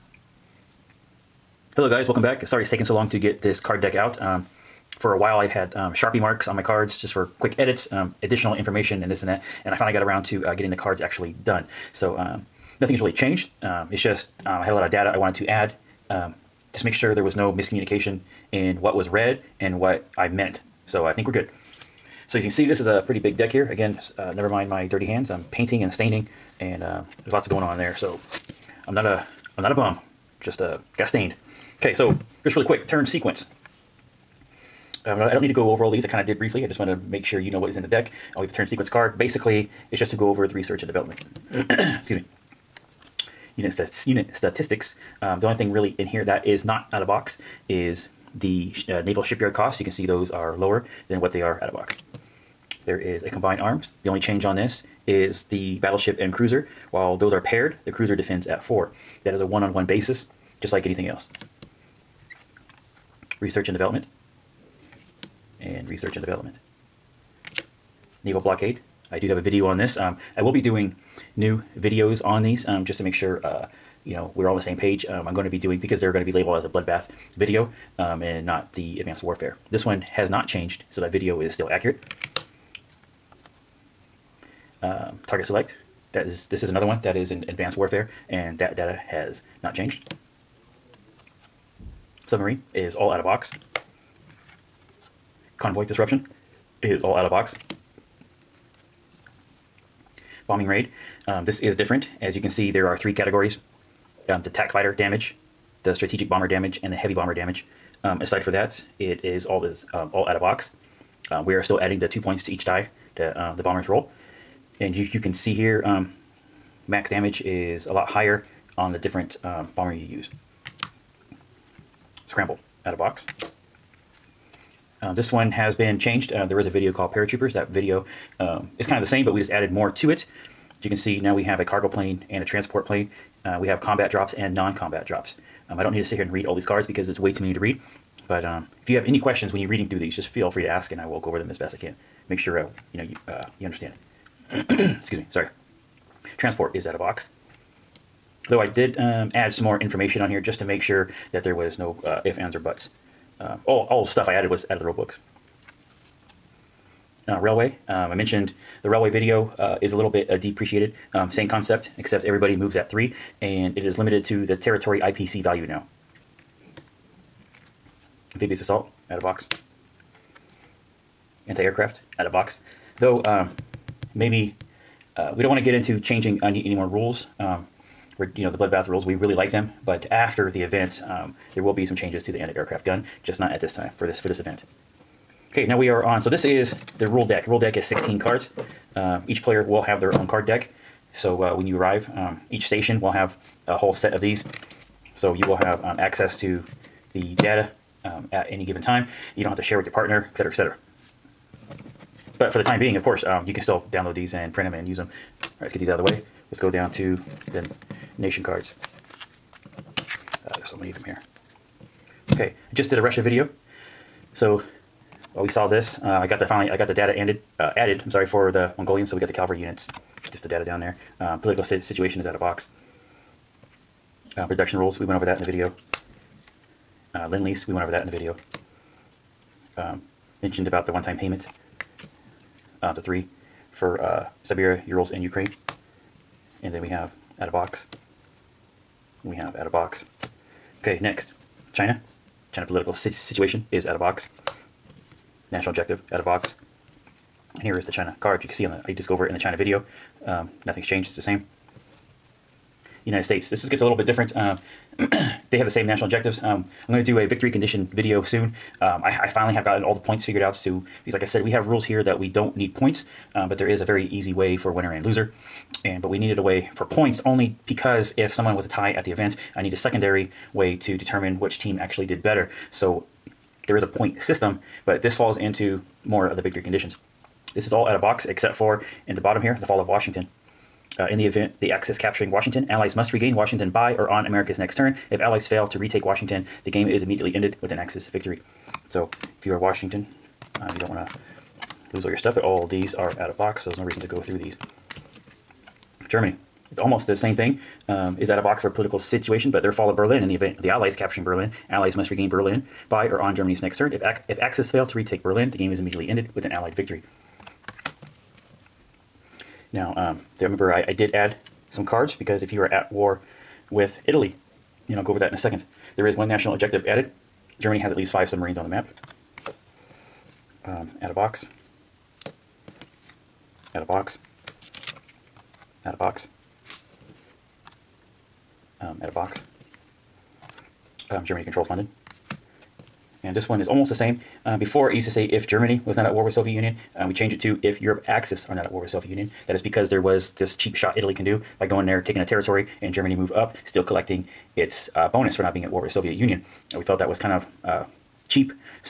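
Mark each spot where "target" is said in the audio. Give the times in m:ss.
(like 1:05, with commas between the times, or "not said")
1:25.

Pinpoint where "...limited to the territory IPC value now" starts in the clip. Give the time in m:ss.
2:43.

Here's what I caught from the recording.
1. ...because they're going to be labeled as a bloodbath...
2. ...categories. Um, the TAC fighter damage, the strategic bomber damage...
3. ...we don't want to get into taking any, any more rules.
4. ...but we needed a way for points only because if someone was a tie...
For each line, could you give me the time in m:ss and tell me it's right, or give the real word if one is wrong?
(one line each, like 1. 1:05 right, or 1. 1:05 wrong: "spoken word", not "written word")
1. 1:15 right
2. 1:43 right
3. 2:55 wrong: "changing", not "taking"
4. 4:26 right.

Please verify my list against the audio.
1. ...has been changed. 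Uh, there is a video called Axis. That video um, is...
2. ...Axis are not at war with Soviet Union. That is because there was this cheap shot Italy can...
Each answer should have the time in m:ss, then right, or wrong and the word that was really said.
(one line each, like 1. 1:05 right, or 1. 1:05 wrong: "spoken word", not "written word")
1. 2:05 wrong: "Paratroopers", not "Axis"
2. 5:38 right.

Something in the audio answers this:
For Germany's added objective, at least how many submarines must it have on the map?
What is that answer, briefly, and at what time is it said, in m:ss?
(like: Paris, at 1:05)
5, at 5:18.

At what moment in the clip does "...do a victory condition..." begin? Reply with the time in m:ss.
4:17.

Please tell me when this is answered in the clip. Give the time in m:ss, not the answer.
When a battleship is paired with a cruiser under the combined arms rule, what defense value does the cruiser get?
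0:58.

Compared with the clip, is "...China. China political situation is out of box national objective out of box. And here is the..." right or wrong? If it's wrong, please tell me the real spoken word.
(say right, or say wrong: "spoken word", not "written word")
right.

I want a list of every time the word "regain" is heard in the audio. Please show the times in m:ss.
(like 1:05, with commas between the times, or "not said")
4:43, 5:02.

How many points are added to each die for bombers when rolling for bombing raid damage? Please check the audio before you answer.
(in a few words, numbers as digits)
2.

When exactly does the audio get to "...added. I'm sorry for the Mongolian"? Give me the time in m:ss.
3:37.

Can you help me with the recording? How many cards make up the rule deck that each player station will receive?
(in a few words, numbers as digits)
16.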